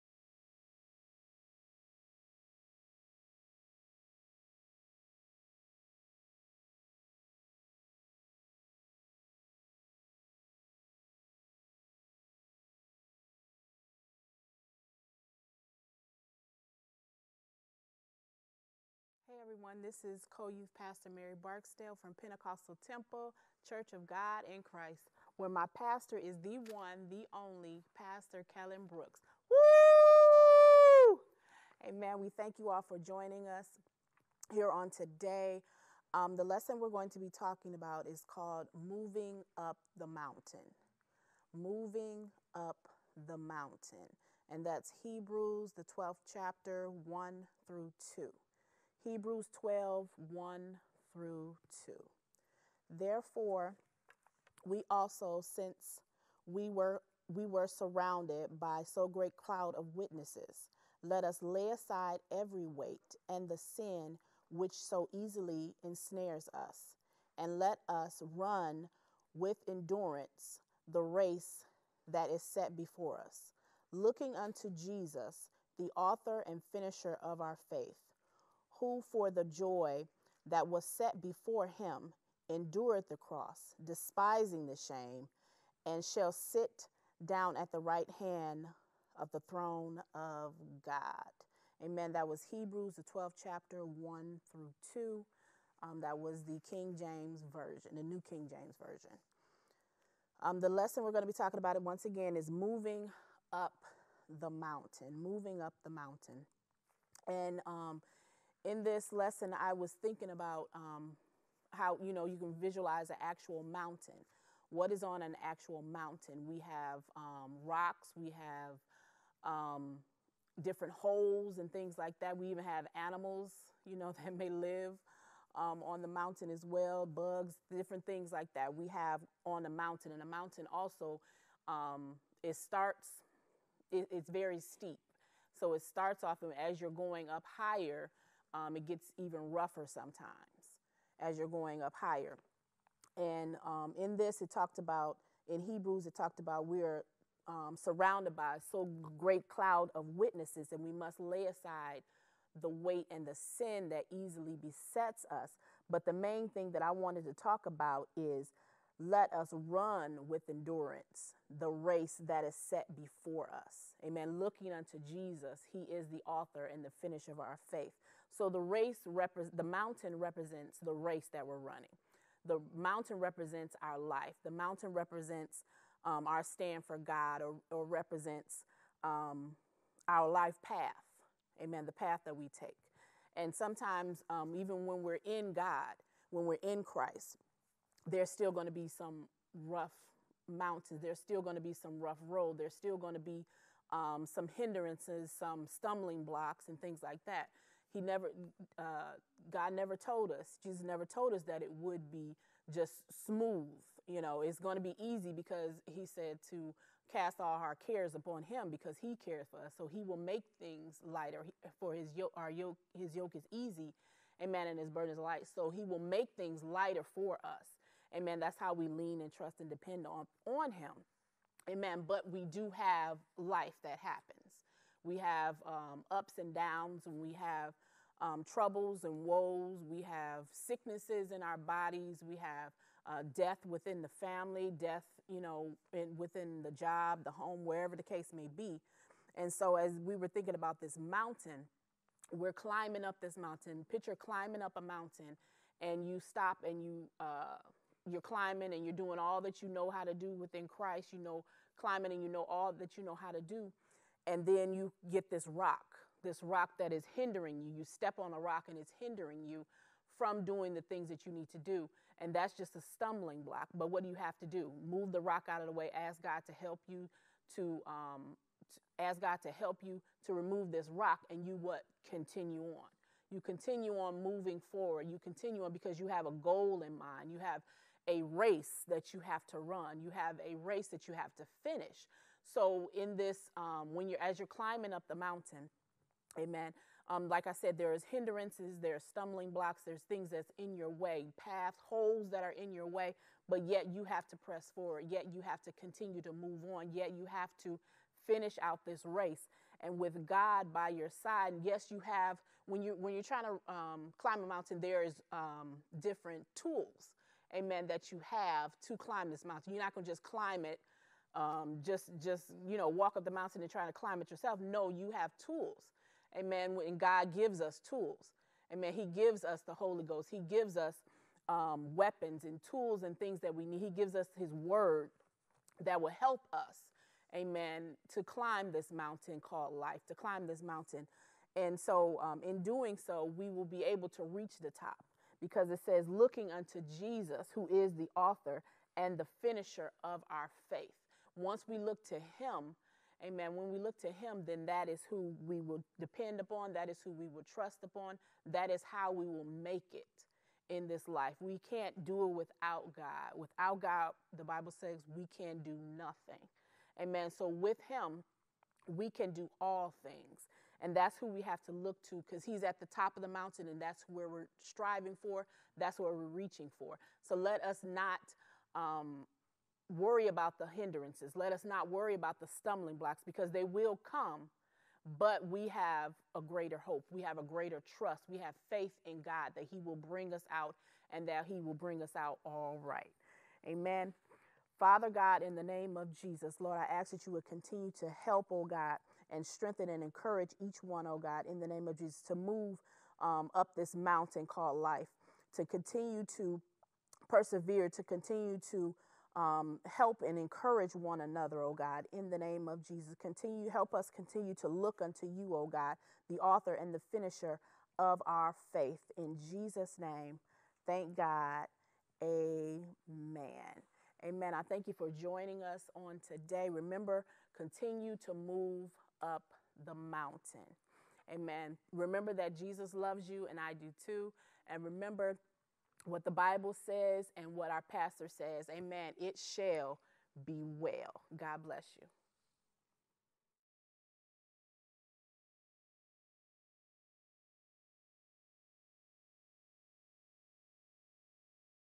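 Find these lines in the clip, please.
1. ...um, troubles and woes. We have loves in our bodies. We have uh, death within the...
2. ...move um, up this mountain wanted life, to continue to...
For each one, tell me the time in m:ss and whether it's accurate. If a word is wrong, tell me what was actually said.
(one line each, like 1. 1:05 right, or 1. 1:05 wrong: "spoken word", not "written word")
1. 3:48 wrong: "sicknesses", not "loves"
2. 6:32 wrong: "called", not "wanted".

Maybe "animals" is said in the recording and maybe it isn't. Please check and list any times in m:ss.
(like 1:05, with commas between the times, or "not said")
2:02.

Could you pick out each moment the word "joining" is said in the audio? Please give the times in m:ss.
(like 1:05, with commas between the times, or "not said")
0:32, 6:55.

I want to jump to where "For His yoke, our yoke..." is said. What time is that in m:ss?
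3:31.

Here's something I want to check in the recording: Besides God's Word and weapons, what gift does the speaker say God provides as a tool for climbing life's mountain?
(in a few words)
the Holy Ghost.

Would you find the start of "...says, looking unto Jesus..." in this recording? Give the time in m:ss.
5:35.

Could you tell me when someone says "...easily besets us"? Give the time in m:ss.
2:34.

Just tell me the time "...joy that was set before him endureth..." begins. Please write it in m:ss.
1:19.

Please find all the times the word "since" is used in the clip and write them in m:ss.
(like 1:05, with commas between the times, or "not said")
0:55.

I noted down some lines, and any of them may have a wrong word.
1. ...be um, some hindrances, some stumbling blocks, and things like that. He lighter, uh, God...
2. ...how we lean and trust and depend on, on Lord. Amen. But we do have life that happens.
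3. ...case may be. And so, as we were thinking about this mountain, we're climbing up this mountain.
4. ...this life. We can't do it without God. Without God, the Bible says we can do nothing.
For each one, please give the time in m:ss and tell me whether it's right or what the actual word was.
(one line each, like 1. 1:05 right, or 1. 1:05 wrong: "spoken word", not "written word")
1. 3:13 wrong: "never", not "lighter"
2. 3:38 wrong: "Him", not "Lord"
3. 3:58 right
4. 5:50 right.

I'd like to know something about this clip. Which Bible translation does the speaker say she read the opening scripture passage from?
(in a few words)
New King James Version.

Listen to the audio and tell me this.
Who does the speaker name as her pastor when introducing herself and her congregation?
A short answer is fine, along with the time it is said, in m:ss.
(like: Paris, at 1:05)
Kellen Brooks, at 0:27.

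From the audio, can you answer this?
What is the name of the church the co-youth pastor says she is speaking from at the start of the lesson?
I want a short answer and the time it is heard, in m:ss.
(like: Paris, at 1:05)
Pentecostal Temple Church of God in Christ, at 0:22.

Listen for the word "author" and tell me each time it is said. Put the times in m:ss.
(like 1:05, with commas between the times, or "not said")
1:15, 2:46, 5:38, 6:46.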